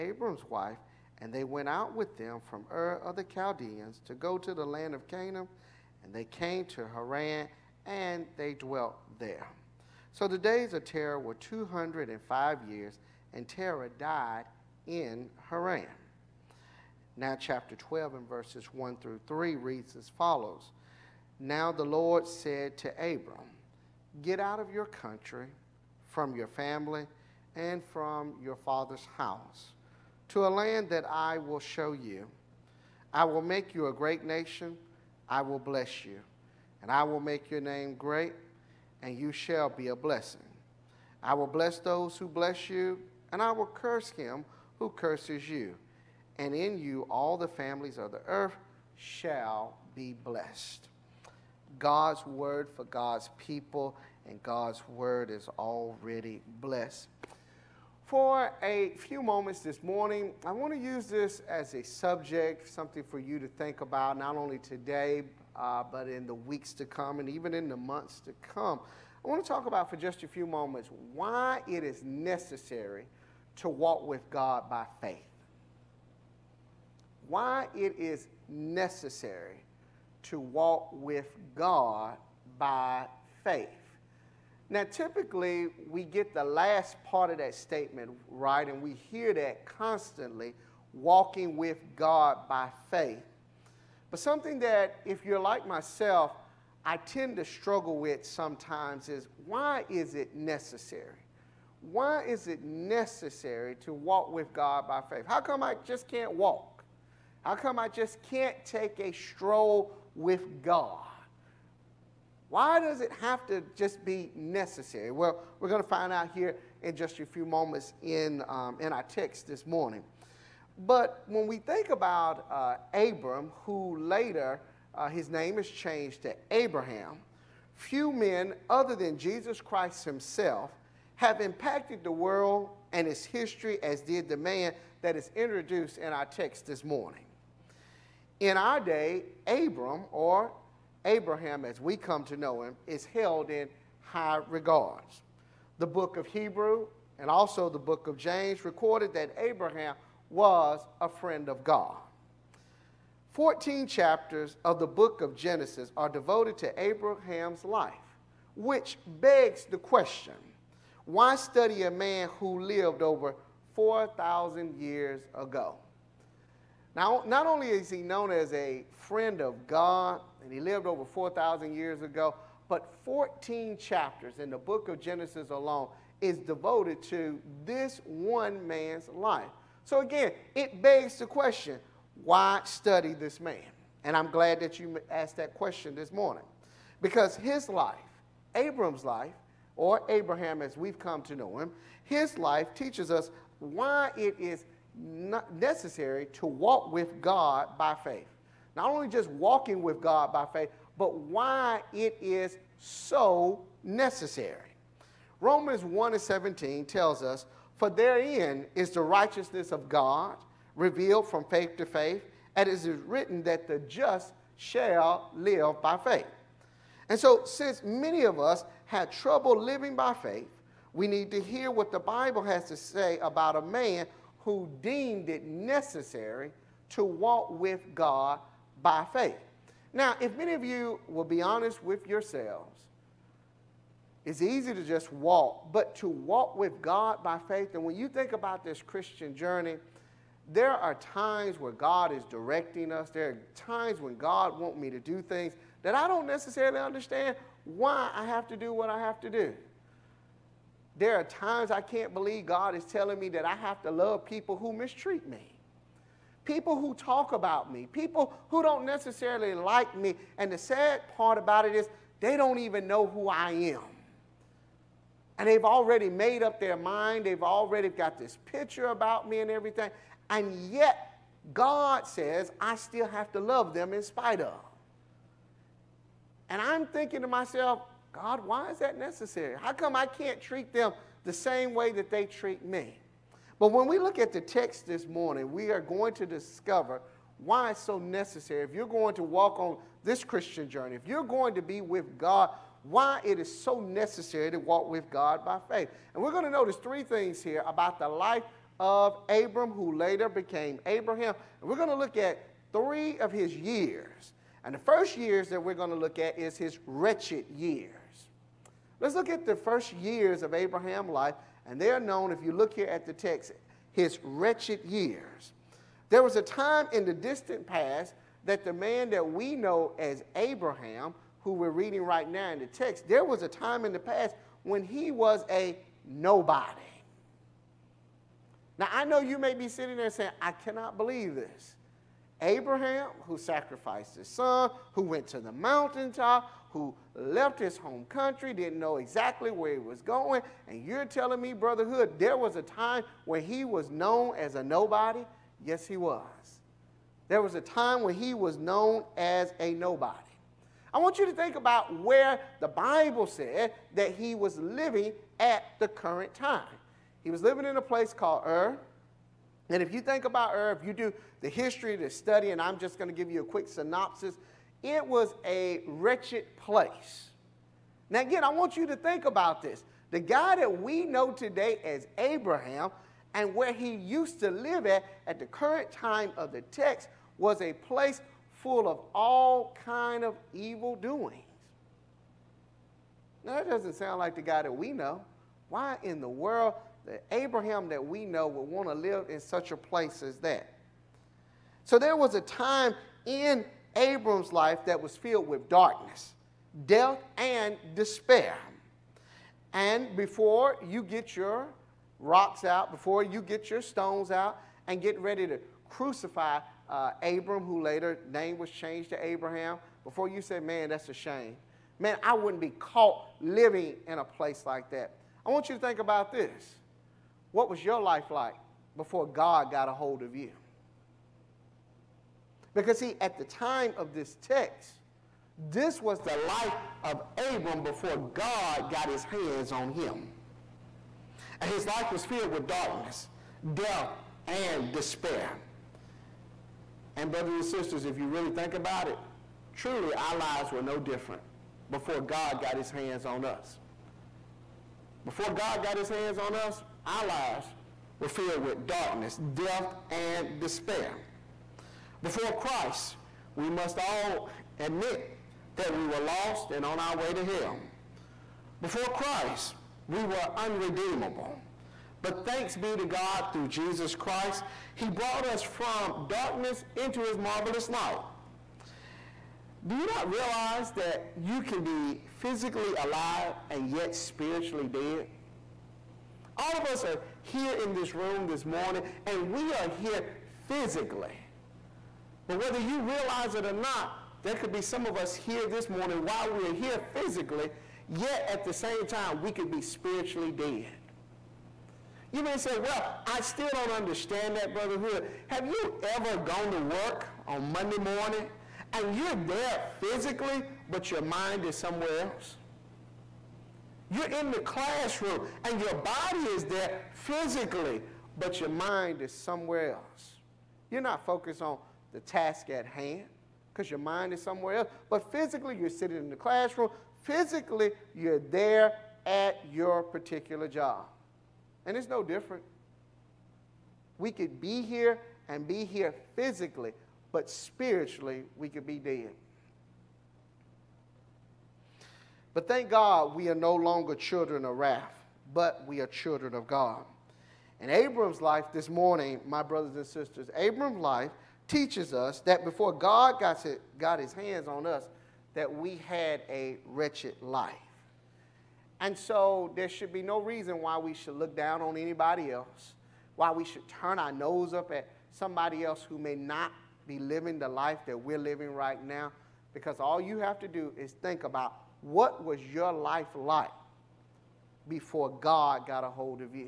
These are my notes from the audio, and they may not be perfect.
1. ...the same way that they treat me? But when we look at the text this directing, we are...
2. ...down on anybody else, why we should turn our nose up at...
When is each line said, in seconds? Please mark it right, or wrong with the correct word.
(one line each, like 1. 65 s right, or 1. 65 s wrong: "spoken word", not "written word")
1. 281 s wrong: "morning", not "directing"
2. 551 s right.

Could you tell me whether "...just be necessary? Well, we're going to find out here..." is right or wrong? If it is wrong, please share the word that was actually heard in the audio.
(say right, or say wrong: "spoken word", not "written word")
right.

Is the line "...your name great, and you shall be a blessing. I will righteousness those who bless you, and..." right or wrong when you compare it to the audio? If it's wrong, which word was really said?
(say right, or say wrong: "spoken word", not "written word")
wrong: "bless", not "righteousness".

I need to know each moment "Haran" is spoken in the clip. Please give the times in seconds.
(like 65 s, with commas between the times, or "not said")
6 s, 15 s.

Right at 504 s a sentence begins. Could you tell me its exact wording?
You're in the classroom and your body is there physically, but your mind is somewhere else.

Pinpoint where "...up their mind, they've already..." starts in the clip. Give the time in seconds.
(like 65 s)
266 s.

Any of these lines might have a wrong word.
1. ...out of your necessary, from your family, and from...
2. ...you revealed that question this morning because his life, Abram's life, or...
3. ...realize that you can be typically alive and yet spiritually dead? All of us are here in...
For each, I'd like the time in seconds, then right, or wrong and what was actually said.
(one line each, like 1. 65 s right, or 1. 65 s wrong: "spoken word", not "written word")
1. 24 s wrong: "country", not "necessary"
2. 184 s wrong: "asked", not "revealed"
3. 470 s wrong: "physically", not "typically".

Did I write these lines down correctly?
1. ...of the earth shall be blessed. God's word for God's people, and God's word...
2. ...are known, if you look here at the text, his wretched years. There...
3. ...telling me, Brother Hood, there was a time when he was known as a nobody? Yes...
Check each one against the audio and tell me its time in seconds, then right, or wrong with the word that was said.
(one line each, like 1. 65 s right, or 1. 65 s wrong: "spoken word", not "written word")
1. 47 s right
2. 311 s right
3. 341 s right.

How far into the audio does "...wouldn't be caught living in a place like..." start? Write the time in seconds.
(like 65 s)
412 s.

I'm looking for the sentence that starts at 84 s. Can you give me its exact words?
Now, typically, we get the last part of that statement right, and we hear that constantly walking with God by faith.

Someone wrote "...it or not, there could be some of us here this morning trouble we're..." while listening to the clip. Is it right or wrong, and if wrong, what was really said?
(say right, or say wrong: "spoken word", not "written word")
wrong: "while", not "trouble".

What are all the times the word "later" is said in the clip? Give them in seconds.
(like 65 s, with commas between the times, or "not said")
123 s, 299 s, 407 s.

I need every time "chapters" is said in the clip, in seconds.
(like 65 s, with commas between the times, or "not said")
17 s, 153 s, 173 s.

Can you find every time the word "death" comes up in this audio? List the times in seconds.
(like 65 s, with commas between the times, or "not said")
396 s, 433 s, 449 s.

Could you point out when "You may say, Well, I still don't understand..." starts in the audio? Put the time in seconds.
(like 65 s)
492 s.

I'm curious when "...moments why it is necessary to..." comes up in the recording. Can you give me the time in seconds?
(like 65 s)
70 s.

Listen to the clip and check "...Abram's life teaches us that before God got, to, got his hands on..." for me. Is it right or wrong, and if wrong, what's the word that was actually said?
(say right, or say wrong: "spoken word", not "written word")
right.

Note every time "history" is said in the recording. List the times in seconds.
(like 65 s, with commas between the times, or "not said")
133 s, 361 s.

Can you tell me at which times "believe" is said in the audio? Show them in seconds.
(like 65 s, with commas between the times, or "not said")
252 s, 330 s.